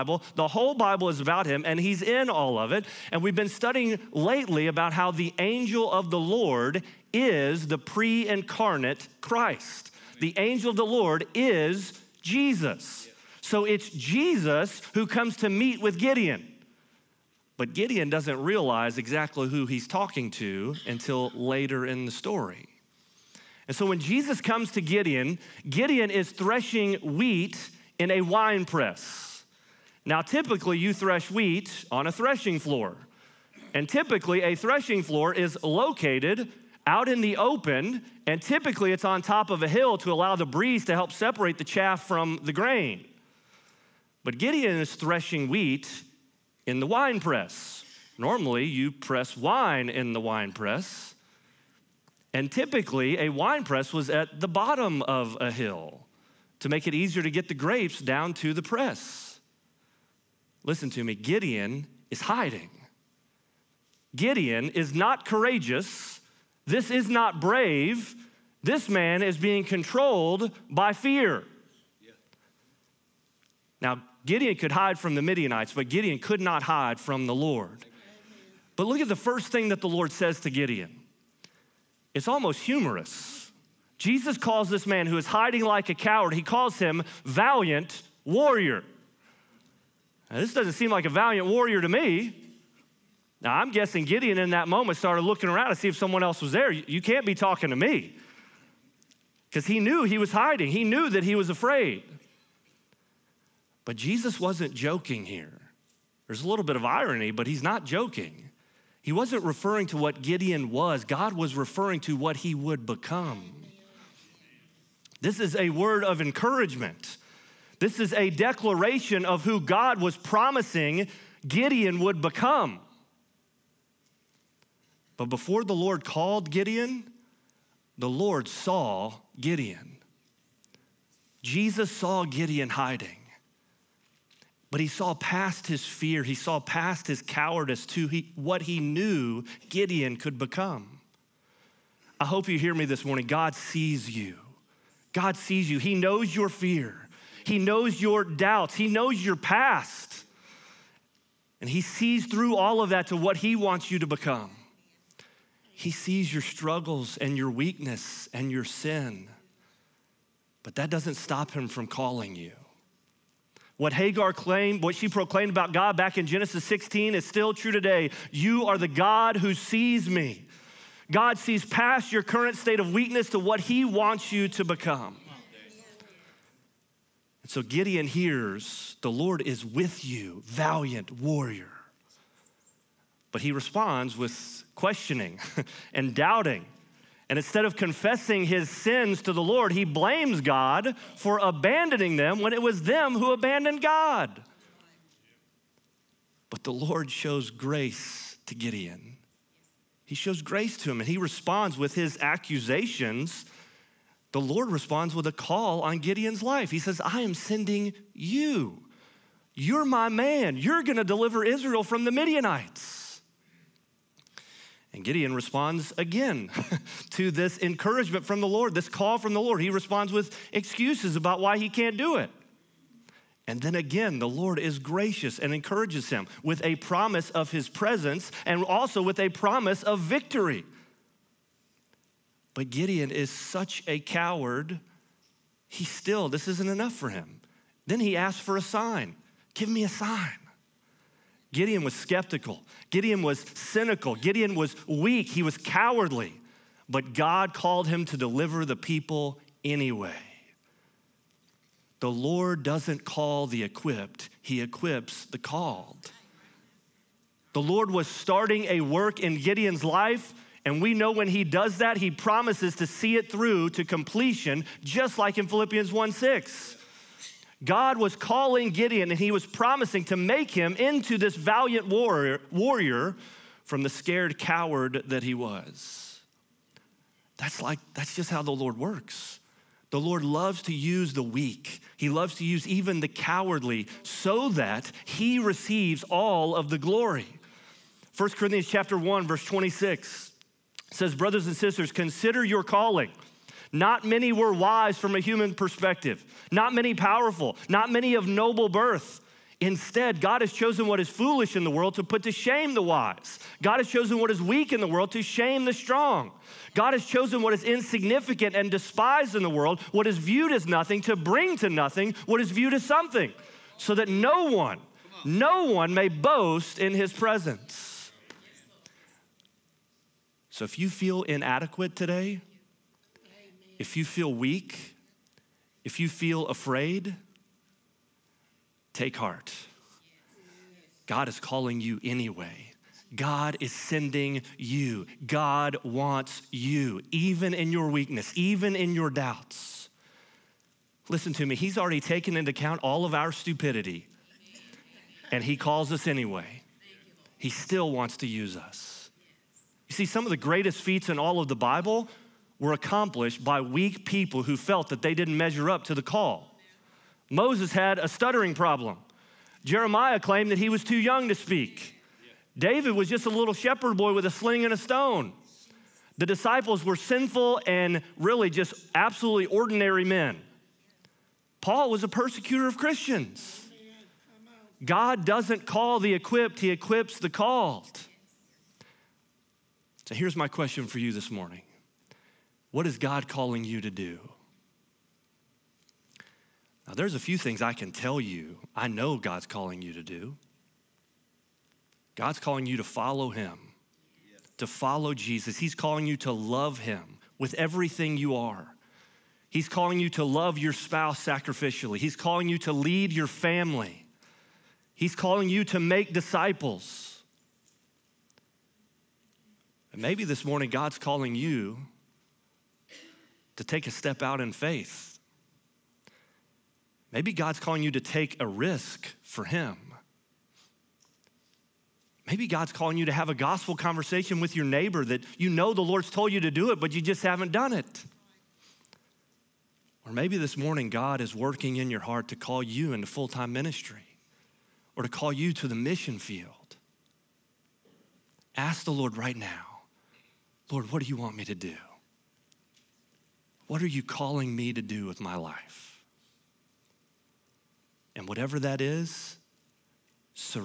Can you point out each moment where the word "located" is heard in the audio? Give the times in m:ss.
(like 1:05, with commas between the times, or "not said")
0:35.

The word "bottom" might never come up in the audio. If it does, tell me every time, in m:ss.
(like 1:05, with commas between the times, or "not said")
0:54.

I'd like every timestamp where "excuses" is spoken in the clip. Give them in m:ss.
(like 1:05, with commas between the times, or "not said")
3:40.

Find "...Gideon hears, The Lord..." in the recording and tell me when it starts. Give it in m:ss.
2:57.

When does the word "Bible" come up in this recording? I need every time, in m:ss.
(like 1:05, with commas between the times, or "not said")
0:00, 5:51.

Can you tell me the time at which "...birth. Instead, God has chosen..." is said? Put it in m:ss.
4:58.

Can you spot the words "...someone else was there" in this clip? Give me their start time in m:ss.
1:35.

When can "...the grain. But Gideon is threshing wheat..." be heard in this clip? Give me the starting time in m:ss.
0:42.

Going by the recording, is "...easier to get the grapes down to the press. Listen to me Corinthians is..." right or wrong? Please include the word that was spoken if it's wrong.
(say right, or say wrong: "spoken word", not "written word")
wrong: "Gideon", not "Corinthians".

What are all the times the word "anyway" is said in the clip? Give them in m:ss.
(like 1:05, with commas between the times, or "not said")
4:09, 5:32, 5:46.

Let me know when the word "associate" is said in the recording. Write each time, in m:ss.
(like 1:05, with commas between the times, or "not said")
not said.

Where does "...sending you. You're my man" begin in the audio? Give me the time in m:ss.
3:27.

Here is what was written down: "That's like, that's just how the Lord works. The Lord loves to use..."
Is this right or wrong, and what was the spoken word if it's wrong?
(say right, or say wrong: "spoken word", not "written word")
right.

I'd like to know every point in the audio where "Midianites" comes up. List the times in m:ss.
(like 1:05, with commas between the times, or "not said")
1:15, 3:32.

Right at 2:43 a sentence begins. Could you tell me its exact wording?
What Hagar claimed, what she proclaimed about God back in Genesis 16 is still true today.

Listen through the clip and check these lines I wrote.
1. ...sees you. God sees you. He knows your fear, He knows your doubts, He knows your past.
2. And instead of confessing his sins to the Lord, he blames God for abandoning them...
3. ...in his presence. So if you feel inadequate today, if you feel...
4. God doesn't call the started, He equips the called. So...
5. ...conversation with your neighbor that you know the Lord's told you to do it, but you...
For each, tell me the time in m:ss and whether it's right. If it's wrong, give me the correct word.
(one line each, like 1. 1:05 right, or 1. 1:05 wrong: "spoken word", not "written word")
1. 2:23 right
2. 3:07 right
3. 5:16 right
4. 6:14 wrong: "equipped", not "started"
5. 7:03 right.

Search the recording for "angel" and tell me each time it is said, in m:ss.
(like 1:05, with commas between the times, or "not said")
0:05, 0:10.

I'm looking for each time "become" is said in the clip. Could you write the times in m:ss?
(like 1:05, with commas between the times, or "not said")
1:52, 2:02, 2:20, 2:34, 2:54.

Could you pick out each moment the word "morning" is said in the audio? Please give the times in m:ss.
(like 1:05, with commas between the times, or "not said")
2:23, 6:21, 6:50, 7:10.